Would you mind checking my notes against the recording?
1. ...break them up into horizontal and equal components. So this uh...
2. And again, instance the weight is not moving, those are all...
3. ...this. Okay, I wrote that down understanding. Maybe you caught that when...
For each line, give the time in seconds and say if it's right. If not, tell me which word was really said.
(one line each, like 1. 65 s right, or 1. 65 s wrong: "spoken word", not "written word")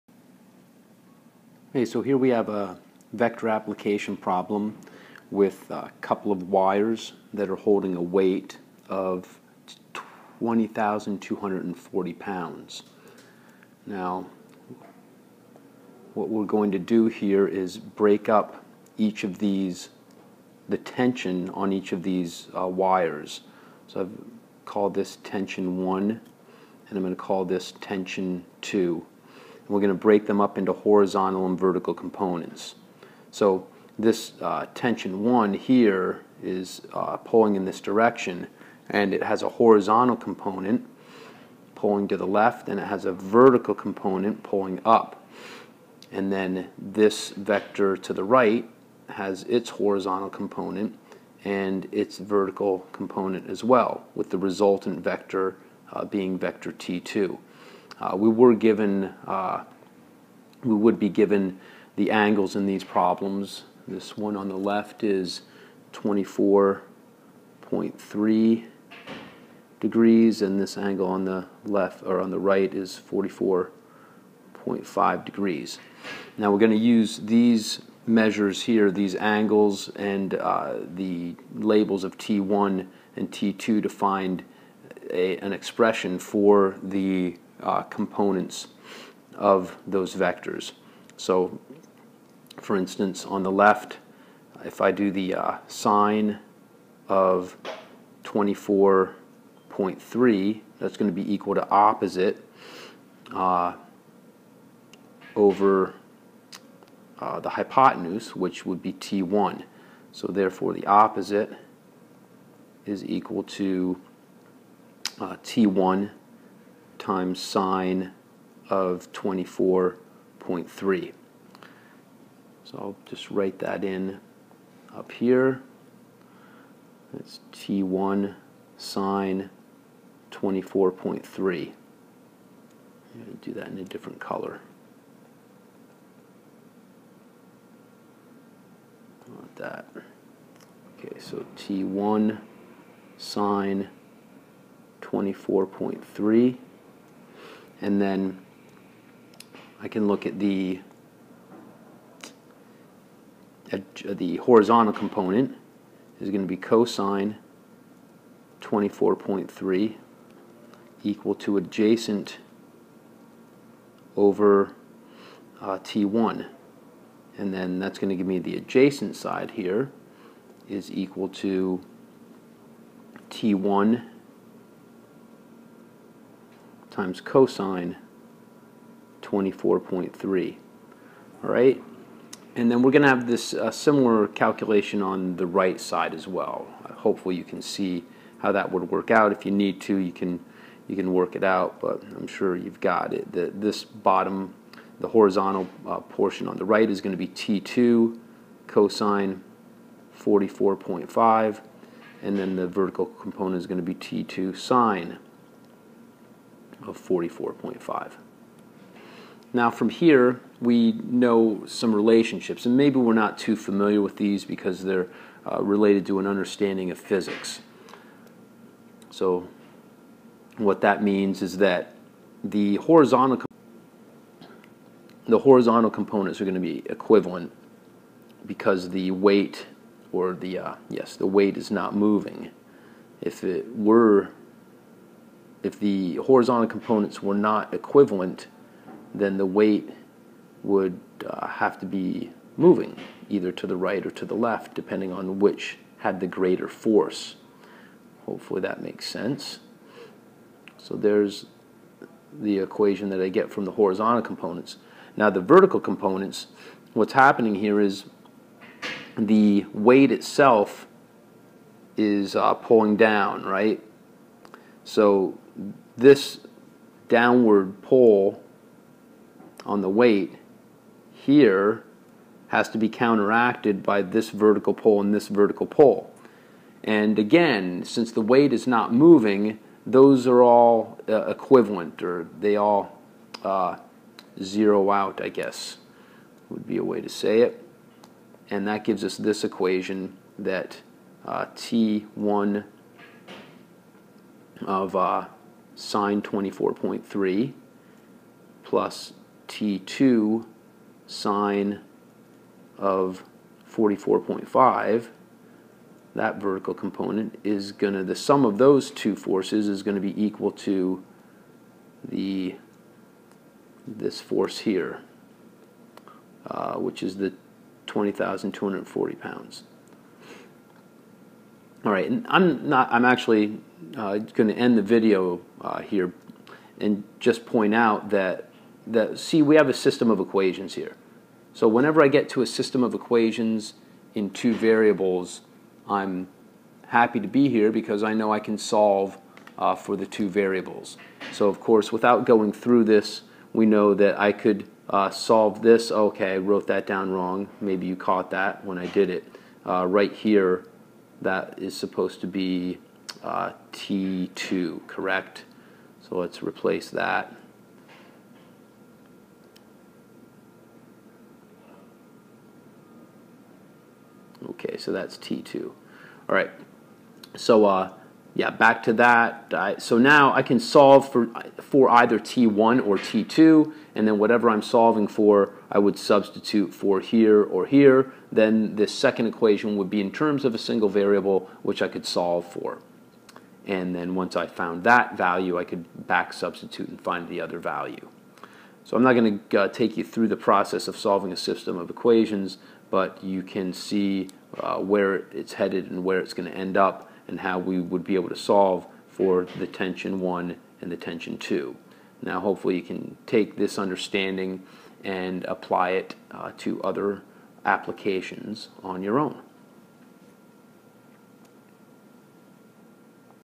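1. 30 s wrong: "vertical", not "equal"
2. 276 s wrong: "since", not "instance"
3. 345 s wrong: "wrong", not "understanding".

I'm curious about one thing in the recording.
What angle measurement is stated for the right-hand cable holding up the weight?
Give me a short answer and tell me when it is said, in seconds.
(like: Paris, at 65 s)
44.5 degrees, at 73 s.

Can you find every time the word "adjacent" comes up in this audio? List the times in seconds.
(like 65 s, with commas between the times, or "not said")
161 s, 168 s.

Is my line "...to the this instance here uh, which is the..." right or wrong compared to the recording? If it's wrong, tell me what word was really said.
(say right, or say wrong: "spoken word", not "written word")
wrong: "force", not "instance".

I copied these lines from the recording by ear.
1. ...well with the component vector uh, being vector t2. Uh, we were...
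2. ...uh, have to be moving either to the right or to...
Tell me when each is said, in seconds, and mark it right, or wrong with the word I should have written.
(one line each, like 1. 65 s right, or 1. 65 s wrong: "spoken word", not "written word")
1. 53 s wrong: "resultant", not "component"
2. 241 s right.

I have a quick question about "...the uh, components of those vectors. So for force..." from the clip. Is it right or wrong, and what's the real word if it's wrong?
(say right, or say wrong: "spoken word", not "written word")
wrong: "instance", not "force".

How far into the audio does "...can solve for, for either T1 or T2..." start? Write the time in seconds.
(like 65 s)
370 s.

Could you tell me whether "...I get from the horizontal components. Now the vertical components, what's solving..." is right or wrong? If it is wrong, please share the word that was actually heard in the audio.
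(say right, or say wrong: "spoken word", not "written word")
wrong: "happening", not "solving".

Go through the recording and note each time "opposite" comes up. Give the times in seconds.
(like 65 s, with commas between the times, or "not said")
101 s, 110 s.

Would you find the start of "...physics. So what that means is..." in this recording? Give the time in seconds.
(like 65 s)
216 s.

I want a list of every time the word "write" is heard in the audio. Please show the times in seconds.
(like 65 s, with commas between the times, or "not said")
123 s.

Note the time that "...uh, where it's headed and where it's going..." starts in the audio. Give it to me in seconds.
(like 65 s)
394 s.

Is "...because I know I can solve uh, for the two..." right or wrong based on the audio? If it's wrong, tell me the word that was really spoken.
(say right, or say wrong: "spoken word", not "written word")
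right.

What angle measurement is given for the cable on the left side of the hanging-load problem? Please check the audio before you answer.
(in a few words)
24.3 degrees.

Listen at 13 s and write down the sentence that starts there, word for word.
Now, what we're going to do here is break up each of these, the tension on each of these uh, wires.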